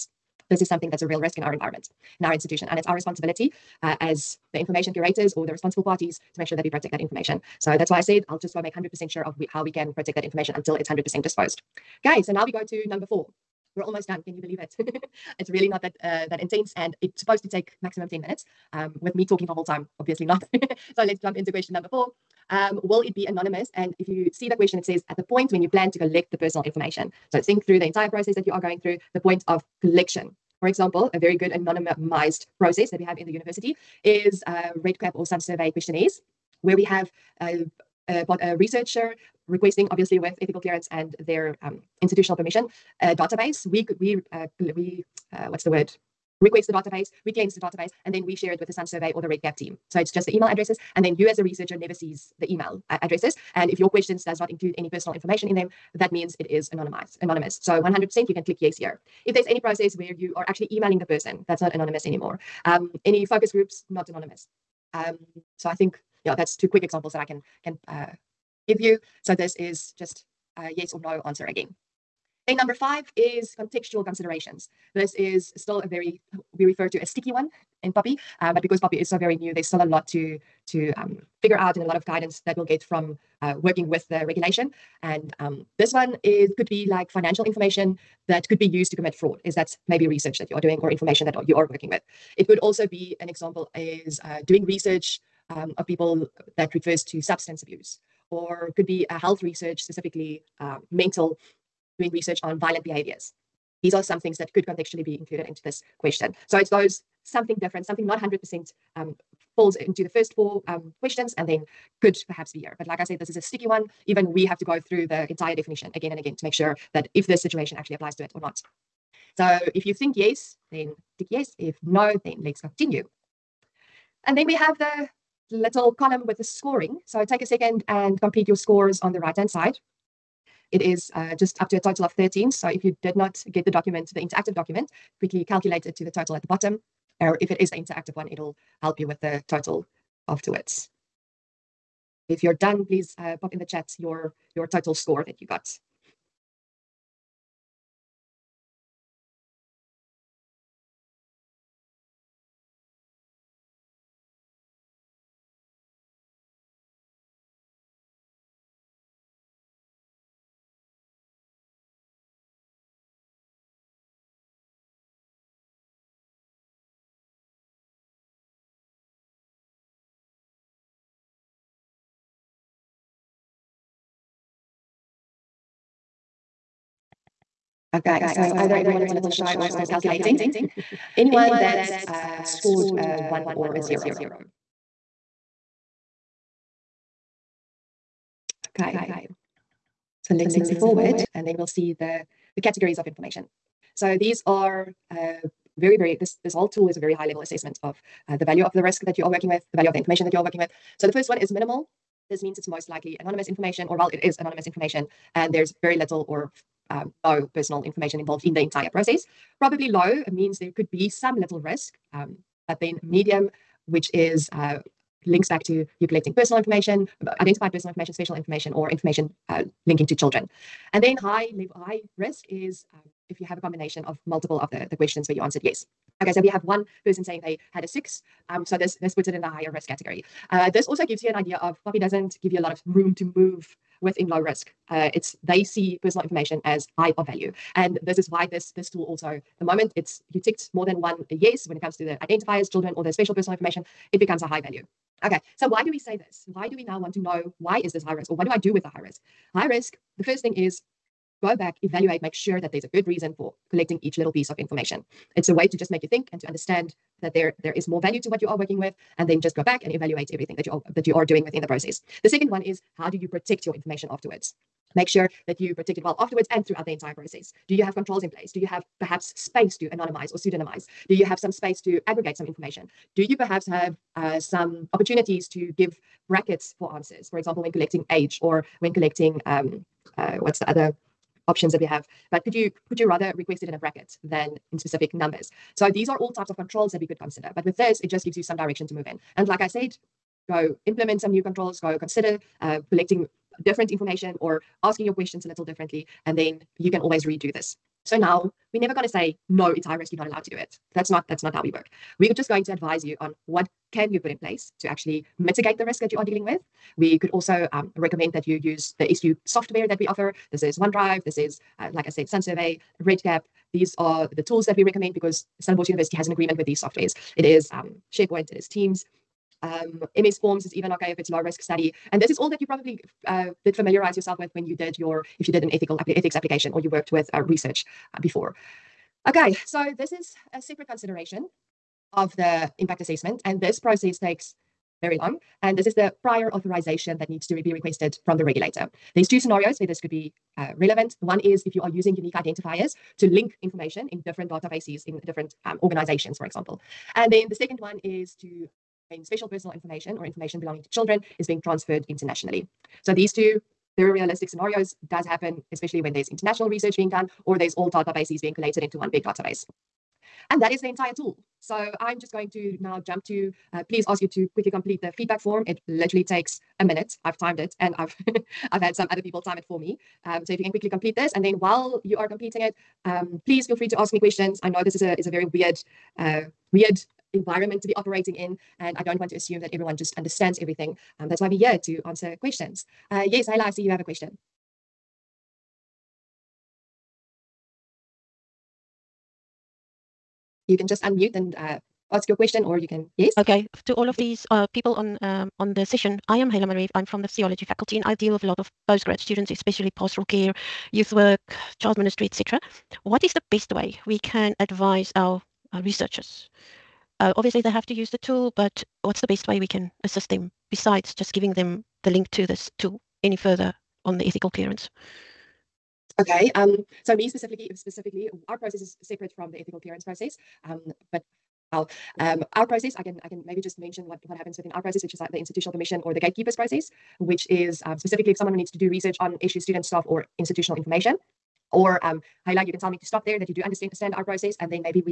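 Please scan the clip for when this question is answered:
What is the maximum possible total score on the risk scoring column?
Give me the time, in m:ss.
2:12.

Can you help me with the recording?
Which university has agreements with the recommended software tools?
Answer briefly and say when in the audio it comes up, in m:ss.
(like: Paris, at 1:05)
Stellenbosch University, at 5:15.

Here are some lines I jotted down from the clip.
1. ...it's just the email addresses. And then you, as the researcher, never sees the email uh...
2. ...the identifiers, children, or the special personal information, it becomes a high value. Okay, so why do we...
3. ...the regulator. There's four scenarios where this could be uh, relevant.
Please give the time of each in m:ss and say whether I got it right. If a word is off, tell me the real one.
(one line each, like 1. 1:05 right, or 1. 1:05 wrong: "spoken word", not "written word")
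1. 0:49 right
2. 4:02 right
3. 5:38 wrong: "two", not "four".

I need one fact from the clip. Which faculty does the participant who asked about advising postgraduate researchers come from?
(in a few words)
Theology.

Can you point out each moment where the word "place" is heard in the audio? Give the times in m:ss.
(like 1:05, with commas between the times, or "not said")
4:28, 5:04.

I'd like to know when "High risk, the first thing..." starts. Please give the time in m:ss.
4:09.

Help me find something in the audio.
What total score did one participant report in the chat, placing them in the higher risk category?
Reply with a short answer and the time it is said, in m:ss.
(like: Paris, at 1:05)
6, at 3:47.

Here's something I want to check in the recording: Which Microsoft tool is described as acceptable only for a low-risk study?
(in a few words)
MS Forms.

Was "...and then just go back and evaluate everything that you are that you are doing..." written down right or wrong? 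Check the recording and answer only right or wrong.
right.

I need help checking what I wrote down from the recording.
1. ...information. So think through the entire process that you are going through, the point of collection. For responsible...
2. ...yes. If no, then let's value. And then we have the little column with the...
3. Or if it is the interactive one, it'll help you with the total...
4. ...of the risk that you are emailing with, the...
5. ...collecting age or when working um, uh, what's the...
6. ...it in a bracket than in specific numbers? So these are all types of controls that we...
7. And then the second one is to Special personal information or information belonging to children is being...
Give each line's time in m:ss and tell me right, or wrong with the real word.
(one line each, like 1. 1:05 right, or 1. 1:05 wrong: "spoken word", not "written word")
1. 0:26 wrong: "example", not "responsible"
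2. 2:01 wrong: "continue", not "value"
3. 2:17 right
4. 3:18 wrong: "working", not "emailing"
5. 4:37 wrong: "collecting", not "working"
6. 4:43 right
7. 5:47 right.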